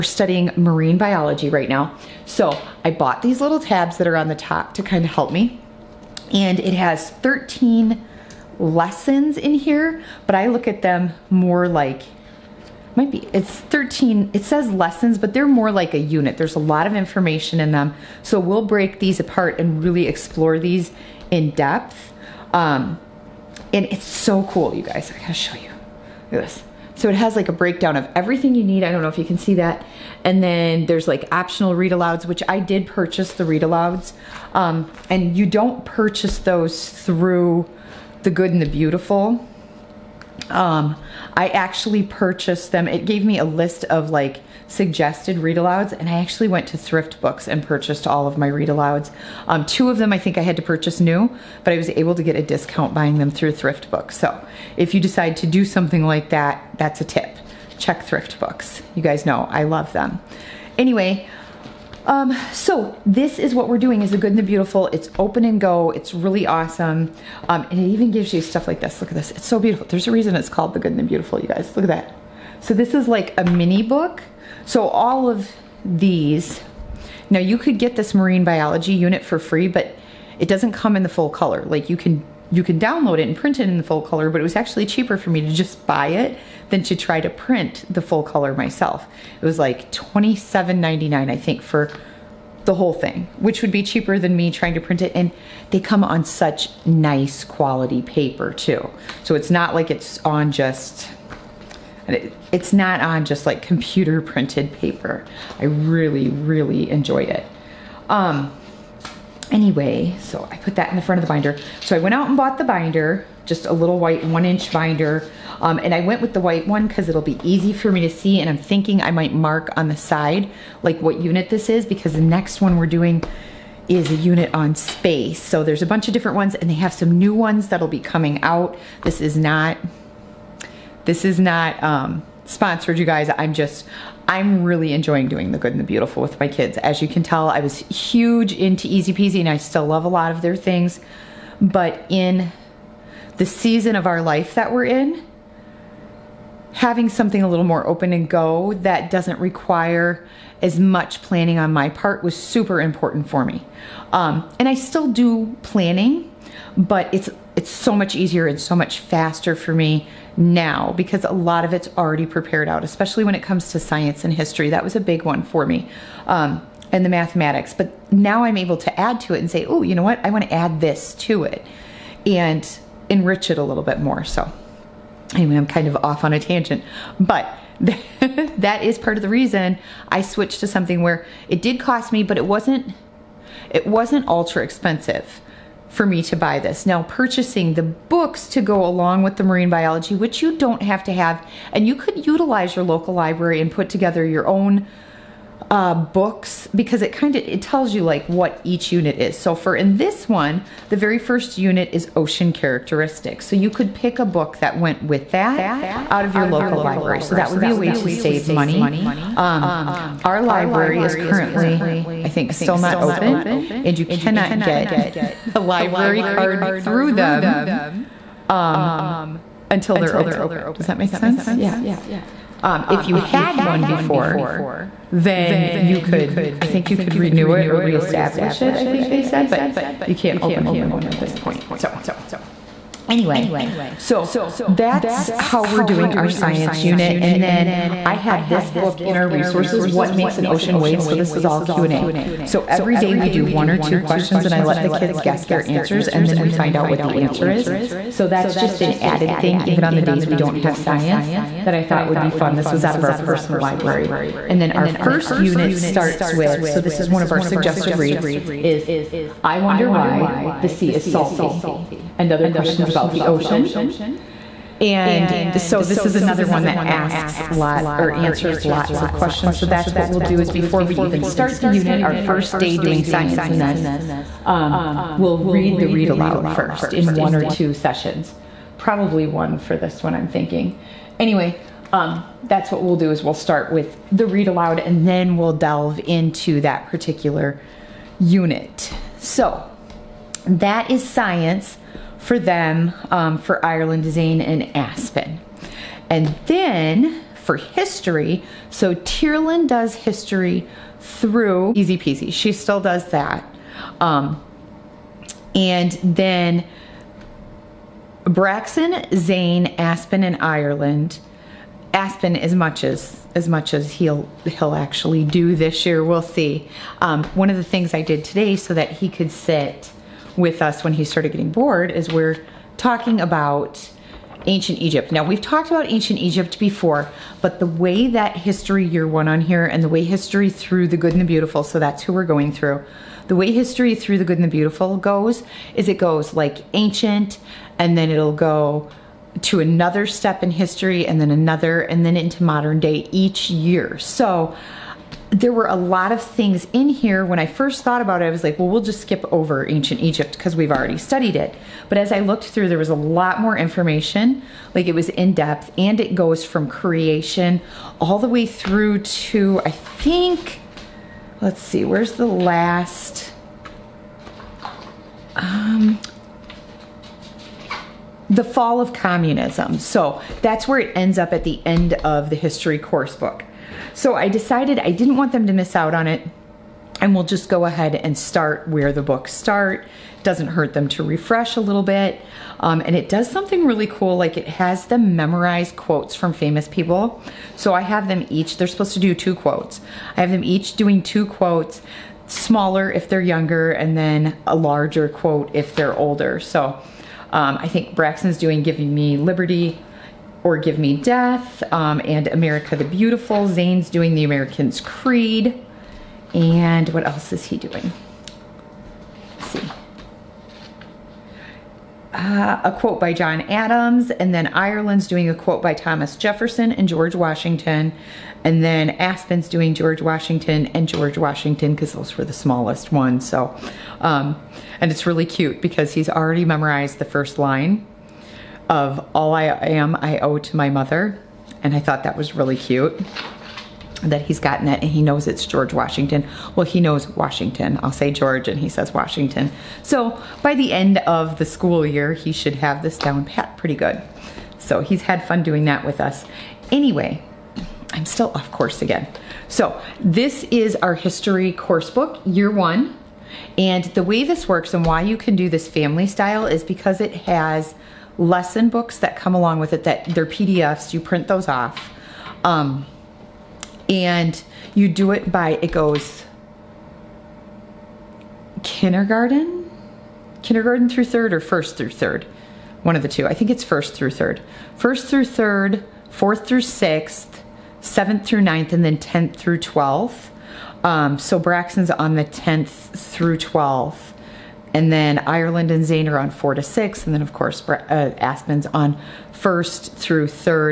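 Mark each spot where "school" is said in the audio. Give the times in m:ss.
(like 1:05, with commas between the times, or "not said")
7:21.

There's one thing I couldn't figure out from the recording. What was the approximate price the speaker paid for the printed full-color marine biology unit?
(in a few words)
$27.99.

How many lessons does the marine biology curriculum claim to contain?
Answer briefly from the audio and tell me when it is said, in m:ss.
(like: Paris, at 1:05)
13, at 0:07.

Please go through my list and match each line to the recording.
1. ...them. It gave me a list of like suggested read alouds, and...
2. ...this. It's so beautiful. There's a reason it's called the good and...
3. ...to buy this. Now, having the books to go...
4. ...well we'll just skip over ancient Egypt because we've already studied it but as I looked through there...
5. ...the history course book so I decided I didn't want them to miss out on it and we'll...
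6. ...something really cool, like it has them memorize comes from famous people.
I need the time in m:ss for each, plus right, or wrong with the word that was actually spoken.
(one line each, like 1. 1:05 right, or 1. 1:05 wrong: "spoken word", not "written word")
1. 0:42 right
2. 1:09 right
3. 3:06 wrong: "purchasing", not "having"
4. 5:48 right
5. 6:12 right
6. 6:23 wrong: "quotes", not "comes".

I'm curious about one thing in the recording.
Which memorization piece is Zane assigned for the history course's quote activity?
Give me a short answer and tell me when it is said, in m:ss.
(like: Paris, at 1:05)
The American's Creed, at 6:44.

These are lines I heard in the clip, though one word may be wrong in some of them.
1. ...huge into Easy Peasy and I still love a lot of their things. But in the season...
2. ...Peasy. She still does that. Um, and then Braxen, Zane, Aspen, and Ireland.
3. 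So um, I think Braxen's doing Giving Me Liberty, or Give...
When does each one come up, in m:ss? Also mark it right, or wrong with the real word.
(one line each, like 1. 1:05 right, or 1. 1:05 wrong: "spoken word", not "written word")
1. 2:17 right
2. 5:01 right
3. 6:36 right.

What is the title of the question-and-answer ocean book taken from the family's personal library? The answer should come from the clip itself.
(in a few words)
What Makes an Ocean Wave?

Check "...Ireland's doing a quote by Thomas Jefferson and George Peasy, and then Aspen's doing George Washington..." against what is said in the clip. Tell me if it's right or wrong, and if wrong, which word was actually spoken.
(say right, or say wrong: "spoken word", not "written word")
wrong: "Washington", not "Peasy".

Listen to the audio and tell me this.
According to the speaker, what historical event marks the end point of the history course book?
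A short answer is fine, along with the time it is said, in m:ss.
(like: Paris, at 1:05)
The fall of communism, at 6:08.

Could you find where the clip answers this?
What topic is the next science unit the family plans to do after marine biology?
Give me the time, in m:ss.
2:04.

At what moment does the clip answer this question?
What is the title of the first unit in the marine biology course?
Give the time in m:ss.
3:22.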